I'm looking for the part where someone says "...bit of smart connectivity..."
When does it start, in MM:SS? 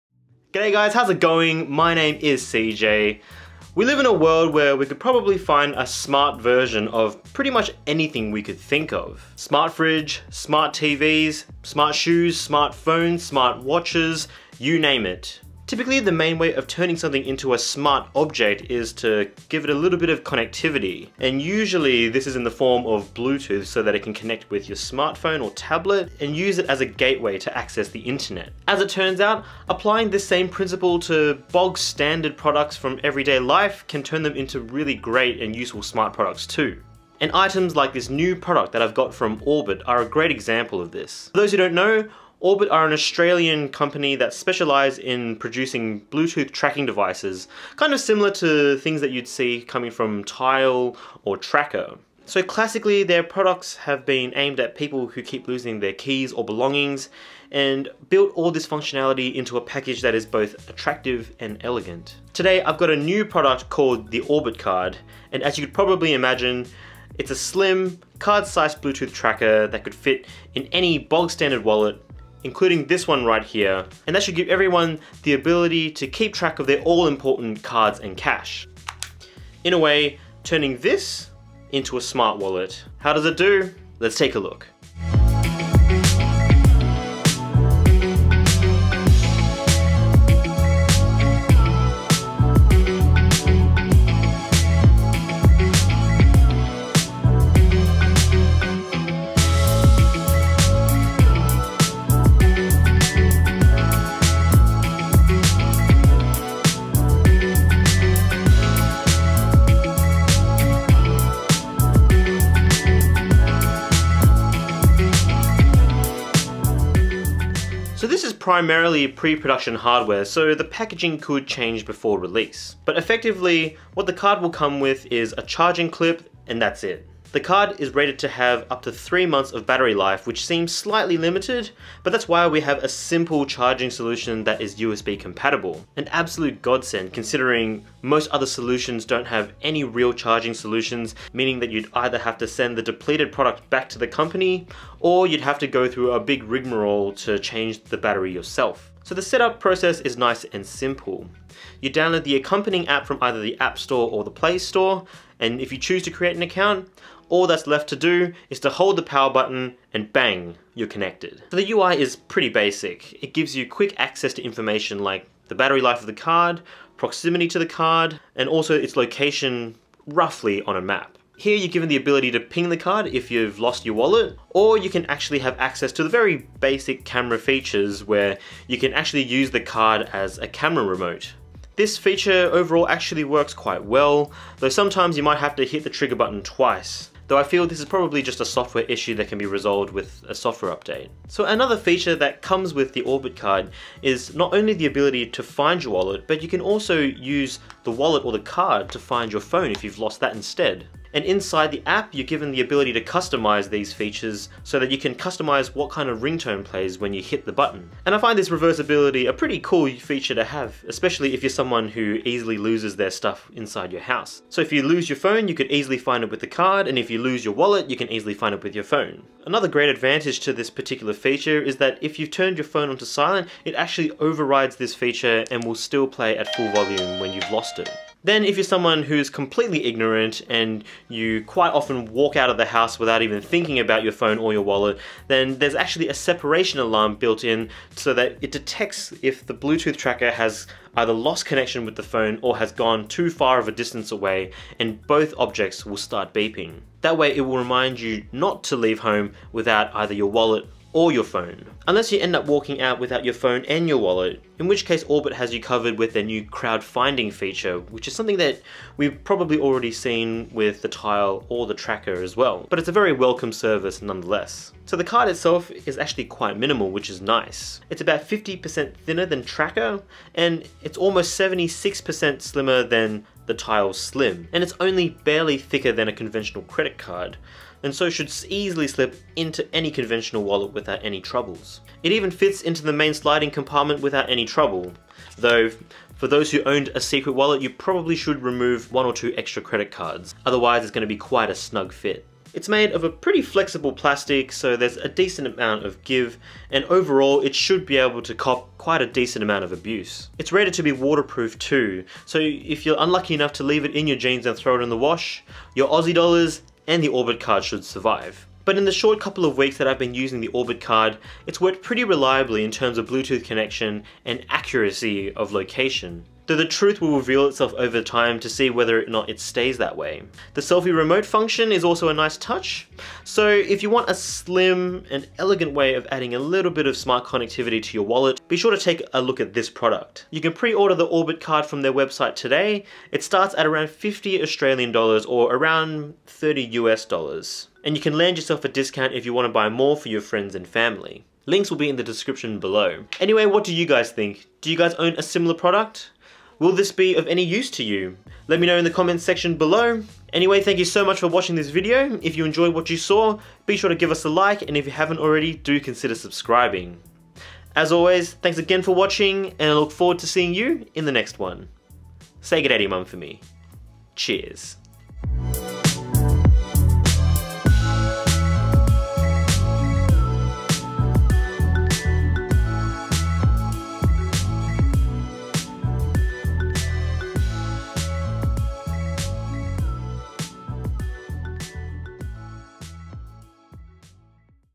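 05:26.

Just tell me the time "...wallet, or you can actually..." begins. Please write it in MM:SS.
02:53.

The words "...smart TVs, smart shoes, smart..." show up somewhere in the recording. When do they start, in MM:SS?
00:10.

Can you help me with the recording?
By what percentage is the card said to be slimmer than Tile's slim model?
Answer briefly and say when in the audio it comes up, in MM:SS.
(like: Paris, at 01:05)
76%, at 04:31.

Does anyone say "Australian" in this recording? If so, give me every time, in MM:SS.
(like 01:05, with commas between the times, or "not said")
00:42, 05:34.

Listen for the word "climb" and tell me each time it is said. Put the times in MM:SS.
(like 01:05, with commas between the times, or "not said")
not said.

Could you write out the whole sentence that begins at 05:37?
And you can land yourself a discount if you want to buy more for your friends and family.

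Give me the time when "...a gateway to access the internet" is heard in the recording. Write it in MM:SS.
00:26.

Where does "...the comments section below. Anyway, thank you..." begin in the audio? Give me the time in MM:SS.
05:48.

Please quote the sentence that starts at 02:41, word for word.
So the UI is pretty basic.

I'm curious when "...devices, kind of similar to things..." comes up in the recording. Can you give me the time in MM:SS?
00:46.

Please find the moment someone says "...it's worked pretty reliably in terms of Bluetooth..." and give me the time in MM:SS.
05:11.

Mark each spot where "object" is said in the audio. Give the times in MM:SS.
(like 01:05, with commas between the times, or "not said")
00:18, 04:05.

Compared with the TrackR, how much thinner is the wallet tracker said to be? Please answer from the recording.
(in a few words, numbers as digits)
50%.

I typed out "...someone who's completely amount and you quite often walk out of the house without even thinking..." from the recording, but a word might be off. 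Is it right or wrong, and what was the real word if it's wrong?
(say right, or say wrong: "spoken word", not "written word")
wrong: "ignorant", not "amount".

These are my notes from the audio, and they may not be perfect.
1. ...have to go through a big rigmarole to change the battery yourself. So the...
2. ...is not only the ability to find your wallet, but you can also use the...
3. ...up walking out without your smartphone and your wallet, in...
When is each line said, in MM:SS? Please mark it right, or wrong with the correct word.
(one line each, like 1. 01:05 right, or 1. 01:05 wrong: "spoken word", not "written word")
1. 02:25 right
2. 03:14 right
3. 04:12 wrong: "phone", not "smartphone".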